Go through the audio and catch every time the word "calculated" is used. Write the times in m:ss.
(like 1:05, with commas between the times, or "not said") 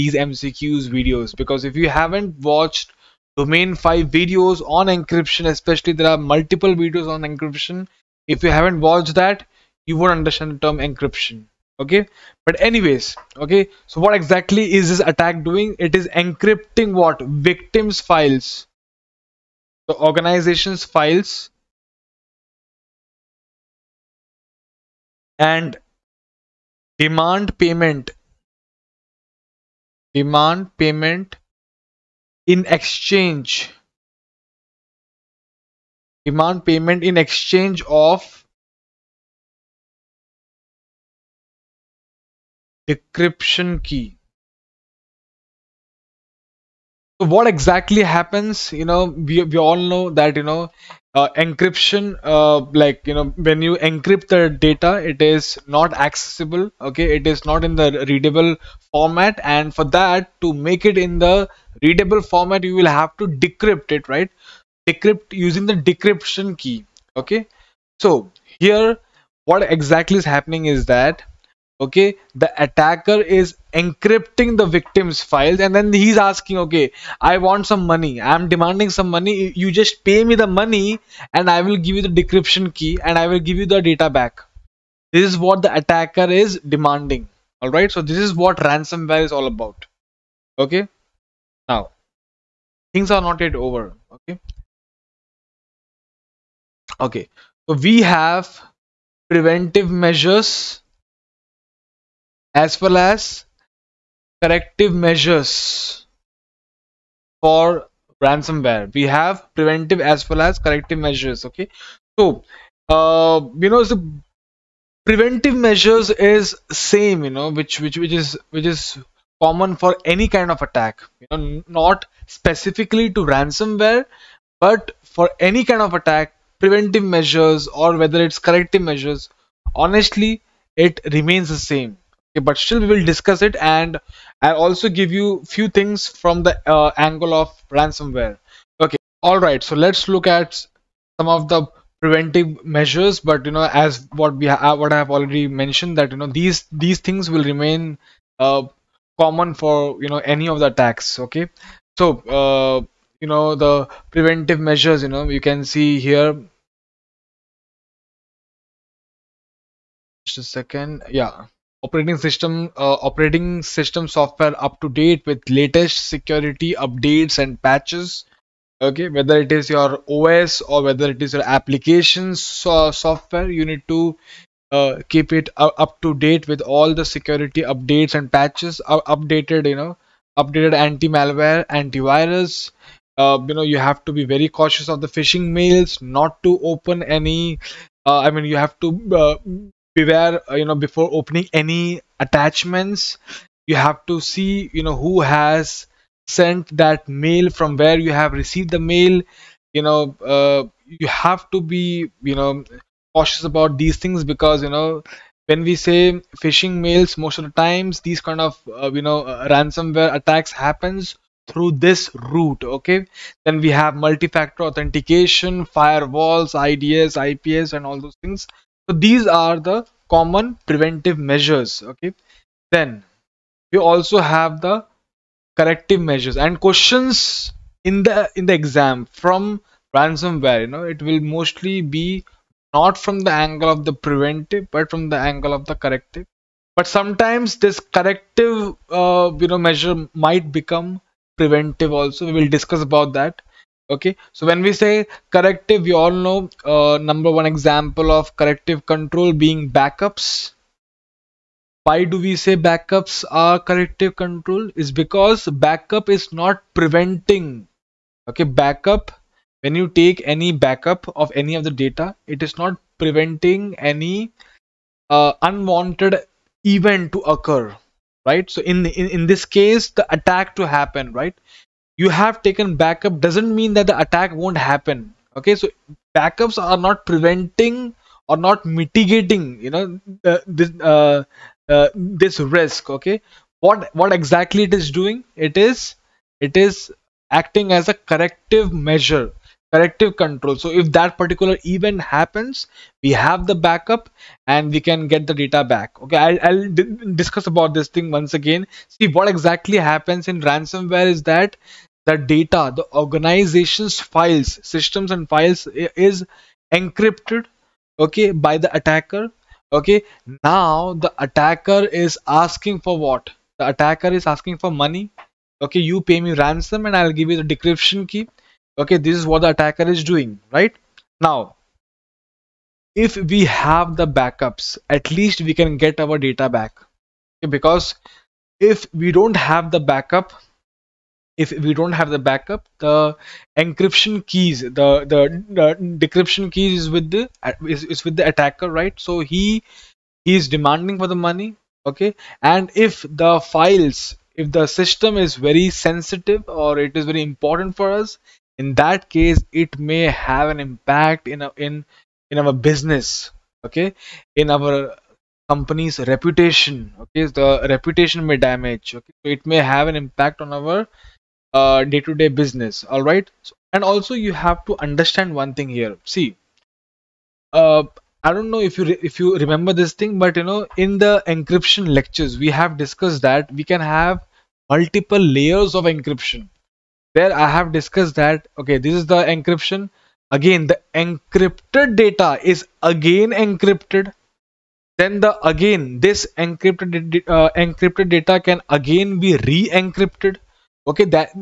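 not said.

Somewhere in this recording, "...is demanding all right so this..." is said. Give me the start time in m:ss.
1:26.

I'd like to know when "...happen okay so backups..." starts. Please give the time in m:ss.
4:34.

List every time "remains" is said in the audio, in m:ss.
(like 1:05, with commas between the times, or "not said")
2:11, 2:27.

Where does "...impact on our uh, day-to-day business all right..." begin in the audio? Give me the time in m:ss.
5:59.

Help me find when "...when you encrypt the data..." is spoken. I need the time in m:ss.
0:53.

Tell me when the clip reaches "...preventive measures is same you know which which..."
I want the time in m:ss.
1:55.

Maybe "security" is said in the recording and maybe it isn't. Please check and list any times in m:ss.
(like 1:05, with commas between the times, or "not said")
2:46, 2:57.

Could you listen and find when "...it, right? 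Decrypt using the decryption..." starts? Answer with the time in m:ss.
1:03.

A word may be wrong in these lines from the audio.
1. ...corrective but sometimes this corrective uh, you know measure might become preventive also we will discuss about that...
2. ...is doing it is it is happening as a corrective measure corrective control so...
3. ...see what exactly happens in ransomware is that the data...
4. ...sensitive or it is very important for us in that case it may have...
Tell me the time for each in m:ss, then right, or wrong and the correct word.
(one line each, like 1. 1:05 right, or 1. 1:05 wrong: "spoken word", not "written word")
1. 3:55 right
2. 4:44 wrong: "acting", not "happening"
3. 4:58 right
4. 5:45 right.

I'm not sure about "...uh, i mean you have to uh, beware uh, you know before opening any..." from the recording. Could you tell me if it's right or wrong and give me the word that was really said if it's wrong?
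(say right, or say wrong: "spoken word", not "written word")
right.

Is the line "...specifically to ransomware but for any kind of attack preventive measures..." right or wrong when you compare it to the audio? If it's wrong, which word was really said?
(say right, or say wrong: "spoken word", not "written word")
right.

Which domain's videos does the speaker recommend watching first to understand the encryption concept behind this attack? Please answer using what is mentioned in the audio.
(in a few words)
Domain 5.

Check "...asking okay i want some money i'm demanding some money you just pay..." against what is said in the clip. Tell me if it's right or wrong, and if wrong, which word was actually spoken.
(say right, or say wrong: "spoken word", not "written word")
right.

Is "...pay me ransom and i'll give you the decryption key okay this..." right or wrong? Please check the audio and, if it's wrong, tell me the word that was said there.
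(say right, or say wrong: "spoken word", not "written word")
right.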